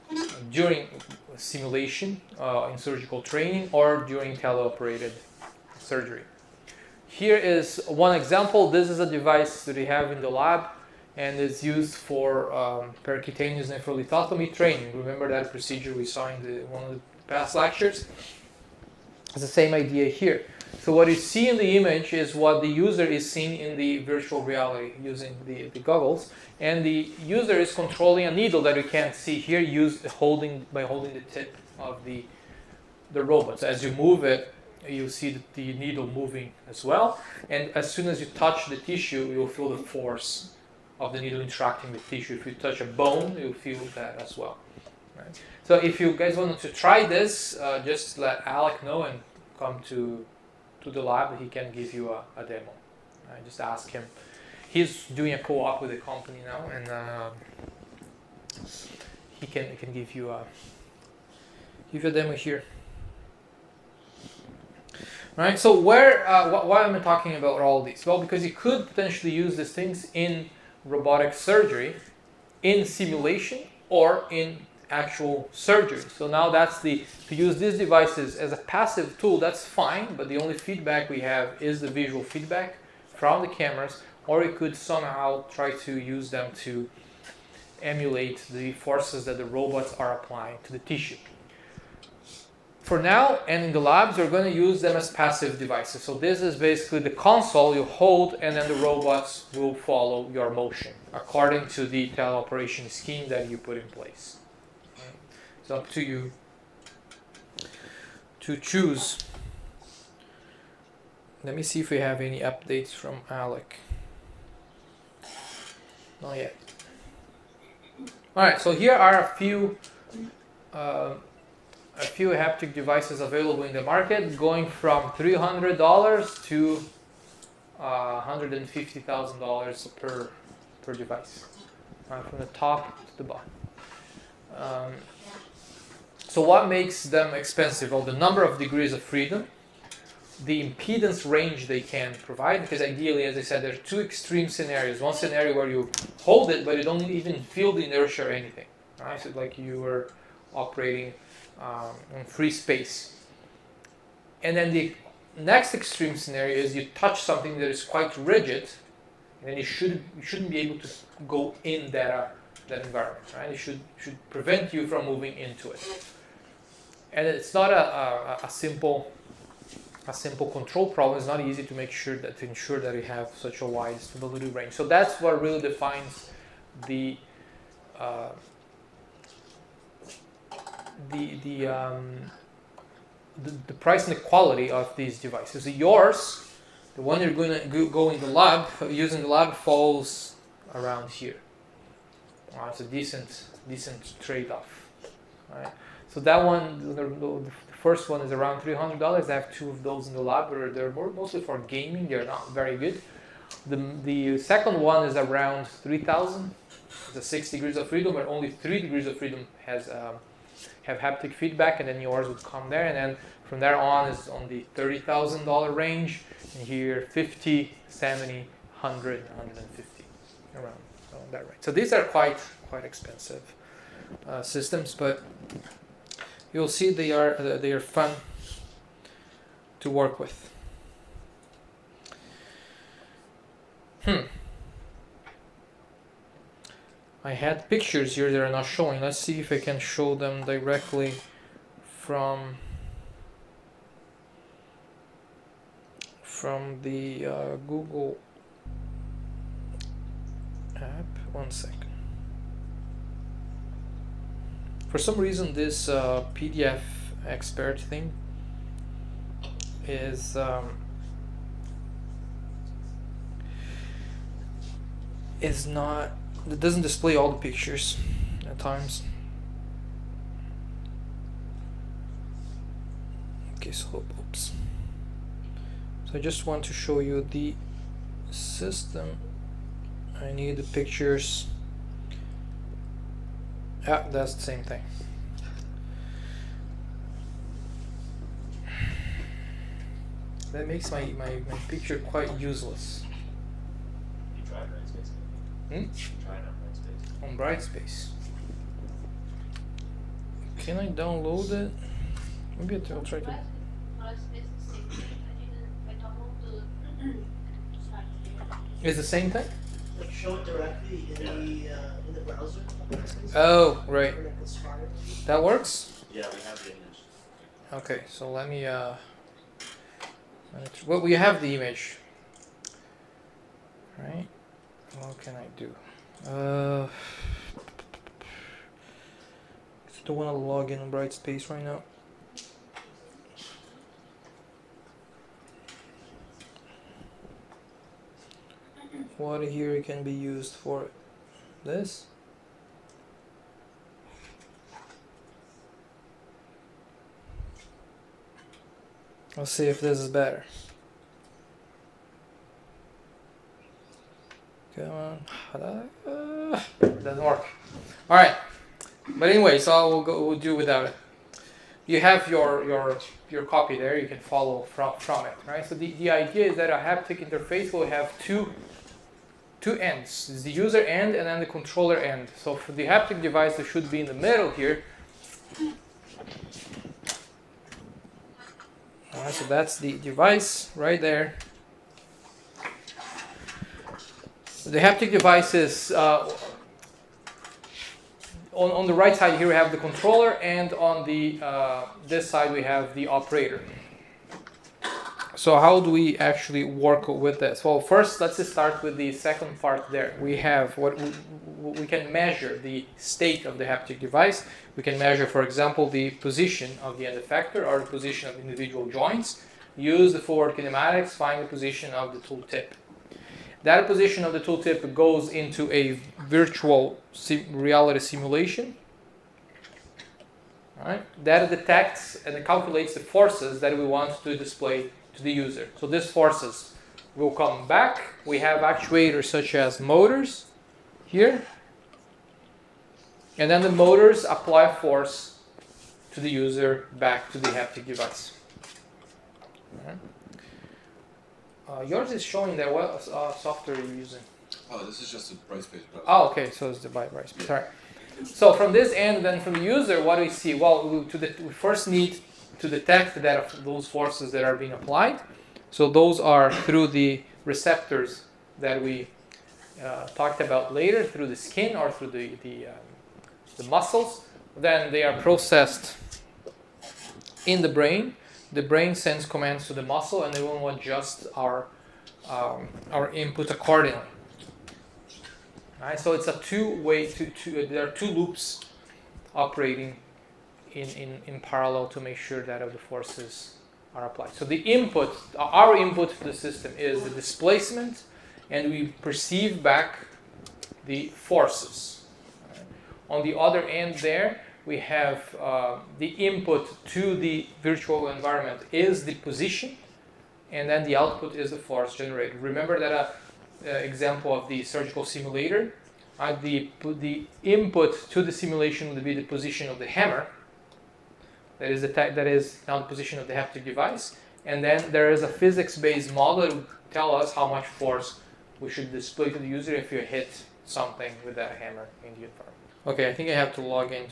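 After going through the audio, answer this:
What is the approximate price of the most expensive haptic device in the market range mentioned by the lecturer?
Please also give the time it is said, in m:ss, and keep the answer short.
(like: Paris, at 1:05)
$150,000, at 2:08.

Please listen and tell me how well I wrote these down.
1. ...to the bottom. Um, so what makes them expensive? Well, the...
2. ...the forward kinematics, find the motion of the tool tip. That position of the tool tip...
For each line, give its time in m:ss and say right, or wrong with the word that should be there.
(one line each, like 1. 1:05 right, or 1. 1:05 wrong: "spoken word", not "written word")
1. 2:13 right
2. 6:50 wrong: "position", not "motion".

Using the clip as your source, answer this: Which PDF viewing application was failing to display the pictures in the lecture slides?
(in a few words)
PDF expert.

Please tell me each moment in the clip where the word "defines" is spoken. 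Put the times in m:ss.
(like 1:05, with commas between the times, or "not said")
2:55.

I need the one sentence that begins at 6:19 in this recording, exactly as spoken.
so that's the device right there.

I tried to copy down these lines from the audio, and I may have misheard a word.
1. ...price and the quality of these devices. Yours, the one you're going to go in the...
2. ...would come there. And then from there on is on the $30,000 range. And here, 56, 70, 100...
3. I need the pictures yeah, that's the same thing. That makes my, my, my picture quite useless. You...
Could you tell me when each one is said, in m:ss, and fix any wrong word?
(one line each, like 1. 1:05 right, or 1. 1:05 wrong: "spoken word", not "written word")
1. 3:03 right
2. 3:32 wrong: "50", not "56"
3. 4:40 right.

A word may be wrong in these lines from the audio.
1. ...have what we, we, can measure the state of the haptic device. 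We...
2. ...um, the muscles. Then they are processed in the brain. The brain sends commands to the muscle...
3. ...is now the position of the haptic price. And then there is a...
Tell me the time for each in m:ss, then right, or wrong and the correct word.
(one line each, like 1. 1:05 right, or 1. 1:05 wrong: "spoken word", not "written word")
1. 6:40 right
2. 7:42 right
3. 8:32 wrong: "device", not "price".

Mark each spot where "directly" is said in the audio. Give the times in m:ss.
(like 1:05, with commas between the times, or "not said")
4:00, 5:10.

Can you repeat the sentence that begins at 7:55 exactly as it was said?
All right, so it's a two-way.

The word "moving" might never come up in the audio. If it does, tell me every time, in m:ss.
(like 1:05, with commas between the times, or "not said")
0:36, 2:45.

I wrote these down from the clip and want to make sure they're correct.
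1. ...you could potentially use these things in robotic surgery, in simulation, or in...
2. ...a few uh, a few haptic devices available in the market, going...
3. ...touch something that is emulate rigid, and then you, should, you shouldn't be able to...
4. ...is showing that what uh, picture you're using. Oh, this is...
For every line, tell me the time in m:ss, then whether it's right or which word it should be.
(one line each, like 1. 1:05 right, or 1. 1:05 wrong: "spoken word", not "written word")
1. 1:08 right
2. 1:59 right
3. 2:36 wrong: "quite", not "emulate"
4. 7:22 wrong: "software", not "picture".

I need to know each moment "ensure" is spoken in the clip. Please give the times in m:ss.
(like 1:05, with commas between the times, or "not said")
2:52.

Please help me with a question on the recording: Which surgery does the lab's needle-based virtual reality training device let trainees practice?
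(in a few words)
percutaneous nephrolithotomy.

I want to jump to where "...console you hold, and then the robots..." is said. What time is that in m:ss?
1:37.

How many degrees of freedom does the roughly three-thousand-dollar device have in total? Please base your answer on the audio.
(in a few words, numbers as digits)
six.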